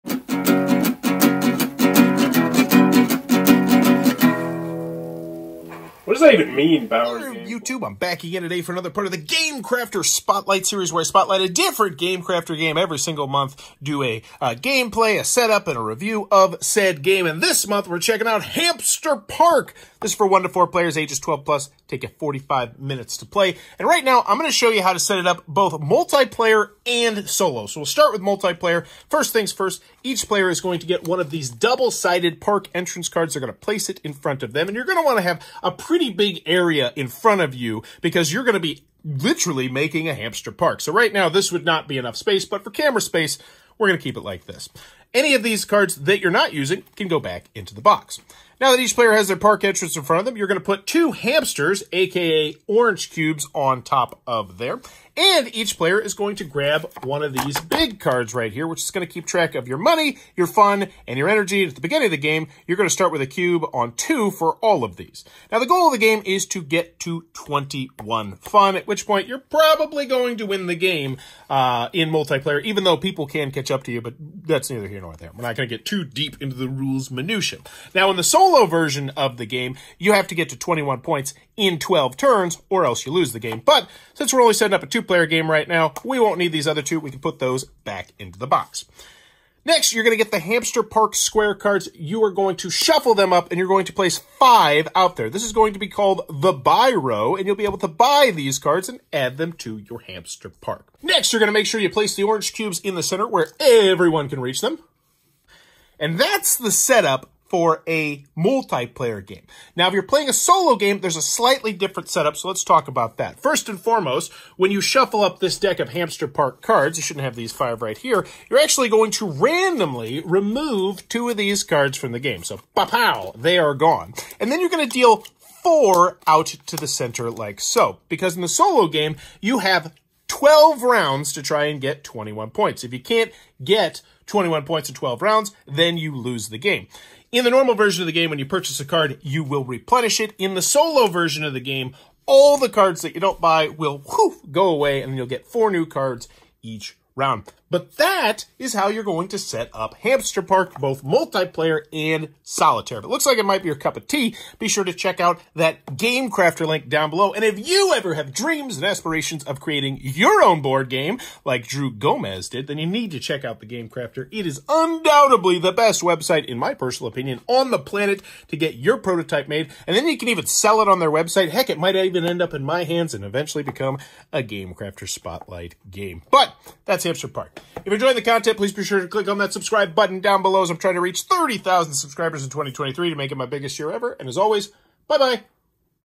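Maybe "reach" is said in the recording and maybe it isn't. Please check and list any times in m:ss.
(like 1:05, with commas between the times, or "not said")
1:44, 3:01.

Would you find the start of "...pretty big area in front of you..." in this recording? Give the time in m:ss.
0:35.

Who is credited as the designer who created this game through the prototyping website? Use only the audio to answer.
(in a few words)
Drew Gomez.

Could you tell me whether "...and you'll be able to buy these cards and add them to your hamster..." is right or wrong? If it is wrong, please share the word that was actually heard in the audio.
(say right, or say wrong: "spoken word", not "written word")
right.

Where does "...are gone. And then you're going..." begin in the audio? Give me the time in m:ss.
2:03.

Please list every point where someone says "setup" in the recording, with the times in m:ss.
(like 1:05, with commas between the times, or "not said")
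0:15, 1:46, 1:52.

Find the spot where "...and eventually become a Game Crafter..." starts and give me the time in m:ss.
2:53.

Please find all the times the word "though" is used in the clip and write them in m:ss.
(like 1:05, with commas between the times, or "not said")
1:12.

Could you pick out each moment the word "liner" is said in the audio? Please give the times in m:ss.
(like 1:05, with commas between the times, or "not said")
not said.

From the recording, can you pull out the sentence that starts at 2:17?
In the normal version of the game, when you purchase a card, you will replenish it.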